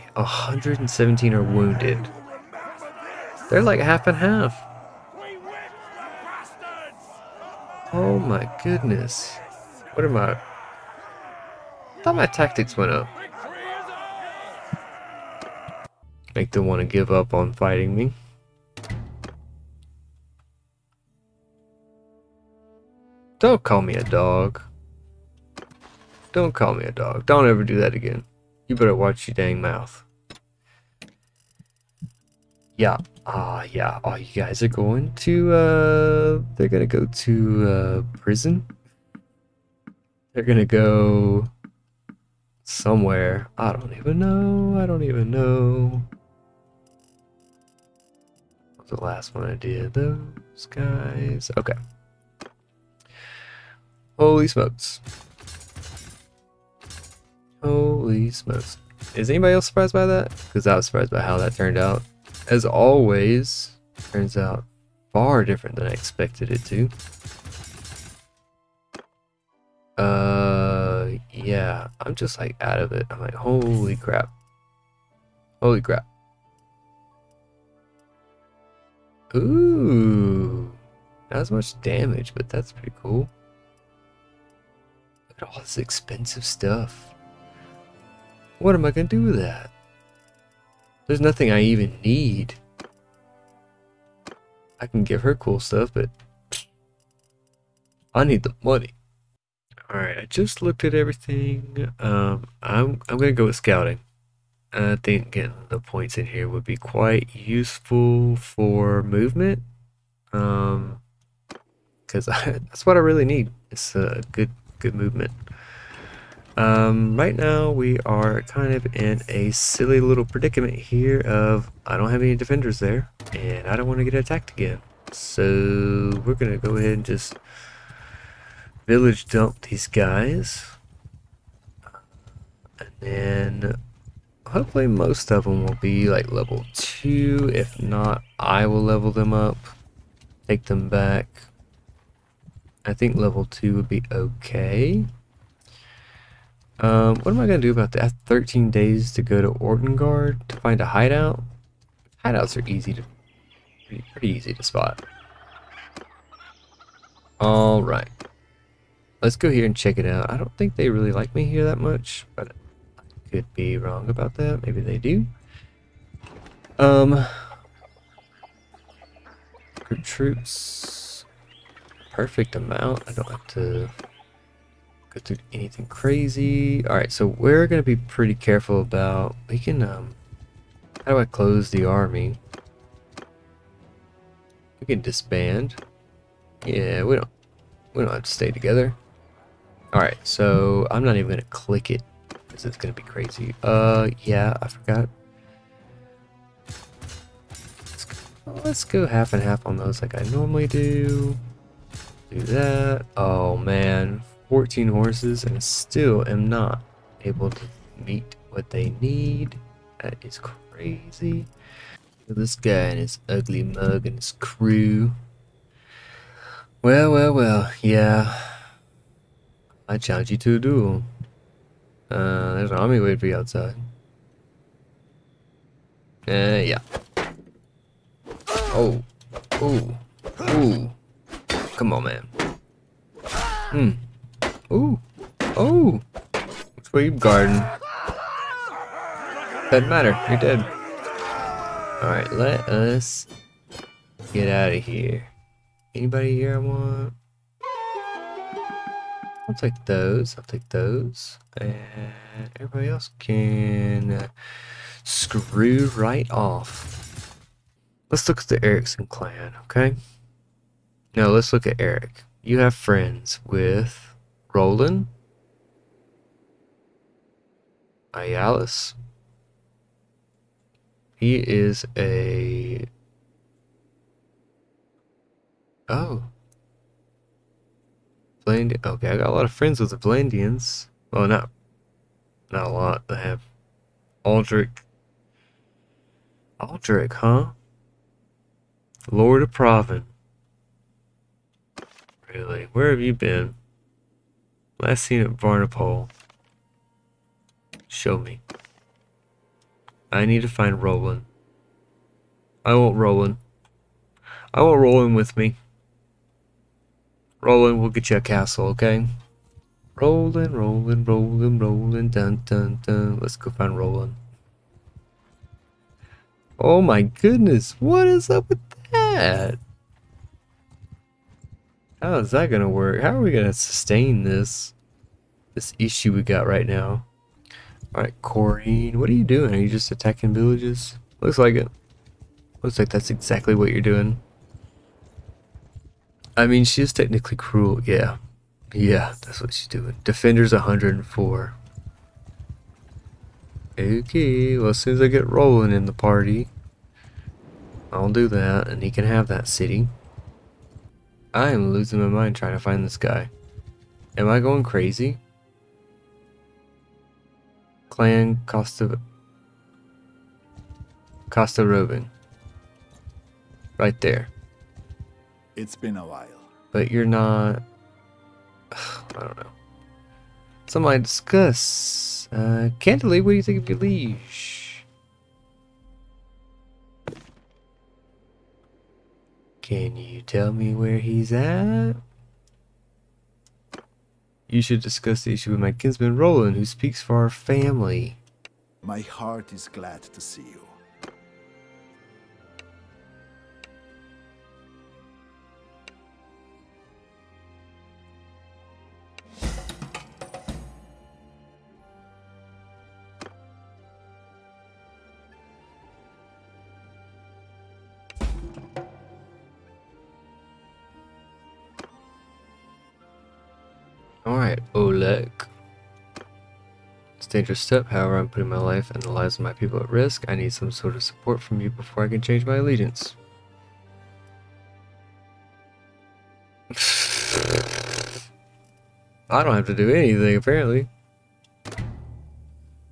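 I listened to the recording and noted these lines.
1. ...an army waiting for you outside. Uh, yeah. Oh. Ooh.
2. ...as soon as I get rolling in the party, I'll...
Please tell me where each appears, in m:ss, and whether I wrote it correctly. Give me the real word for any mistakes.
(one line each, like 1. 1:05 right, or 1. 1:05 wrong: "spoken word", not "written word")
1. 3:42 right
2. 5:44 right.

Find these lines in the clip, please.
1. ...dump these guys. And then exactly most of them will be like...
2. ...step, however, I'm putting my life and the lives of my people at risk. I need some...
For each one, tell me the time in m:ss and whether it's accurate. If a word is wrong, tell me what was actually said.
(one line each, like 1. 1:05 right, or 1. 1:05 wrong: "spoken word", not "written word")
1. 2:09 wrong: "hopefully", not "exactly"
2. 6:57 right.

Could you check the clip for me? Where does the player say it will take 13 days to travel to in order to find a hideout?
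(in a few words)
Ortengard.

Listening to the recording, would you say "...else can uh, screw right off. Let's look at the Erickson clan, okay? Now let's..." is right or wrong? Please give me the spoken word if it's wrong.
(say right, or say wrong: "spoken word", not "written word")
right.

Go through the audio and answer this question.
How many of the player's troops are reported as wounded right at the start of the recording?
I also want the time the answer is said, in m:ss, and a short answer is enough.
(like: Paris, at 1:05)
117, at 0:00.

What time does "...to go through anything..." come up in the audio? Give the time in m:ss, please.
2:53.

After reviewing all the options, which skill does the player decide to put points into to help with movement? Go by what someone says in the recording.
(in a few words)
Scouting.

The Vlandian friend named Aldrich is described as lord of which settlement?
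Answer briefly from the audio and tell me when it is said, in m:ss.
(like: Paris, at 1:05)
Pravend, at 4:49.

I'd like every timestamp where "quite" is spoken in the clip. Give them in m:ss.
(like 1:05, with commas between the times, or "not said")
1:46.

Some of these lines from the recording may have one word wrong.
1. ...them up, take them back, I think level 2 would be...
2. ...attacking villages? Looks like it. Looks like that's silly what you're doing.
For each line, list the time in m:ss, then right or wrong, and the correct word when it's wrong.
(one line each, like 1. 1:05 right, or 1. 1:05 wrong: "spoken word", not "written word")
1. 2:19 right
2. 5:29 wrong: "exactly", not "silly".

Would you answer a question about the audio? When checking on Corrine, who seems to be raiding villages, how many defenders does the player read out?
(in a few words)
104.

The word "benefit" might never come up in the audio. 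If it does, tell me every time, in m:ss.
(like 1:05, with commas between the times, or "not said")
not said.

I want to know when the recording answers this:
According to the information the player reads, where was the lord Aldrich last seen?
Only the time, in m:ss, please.
4:55.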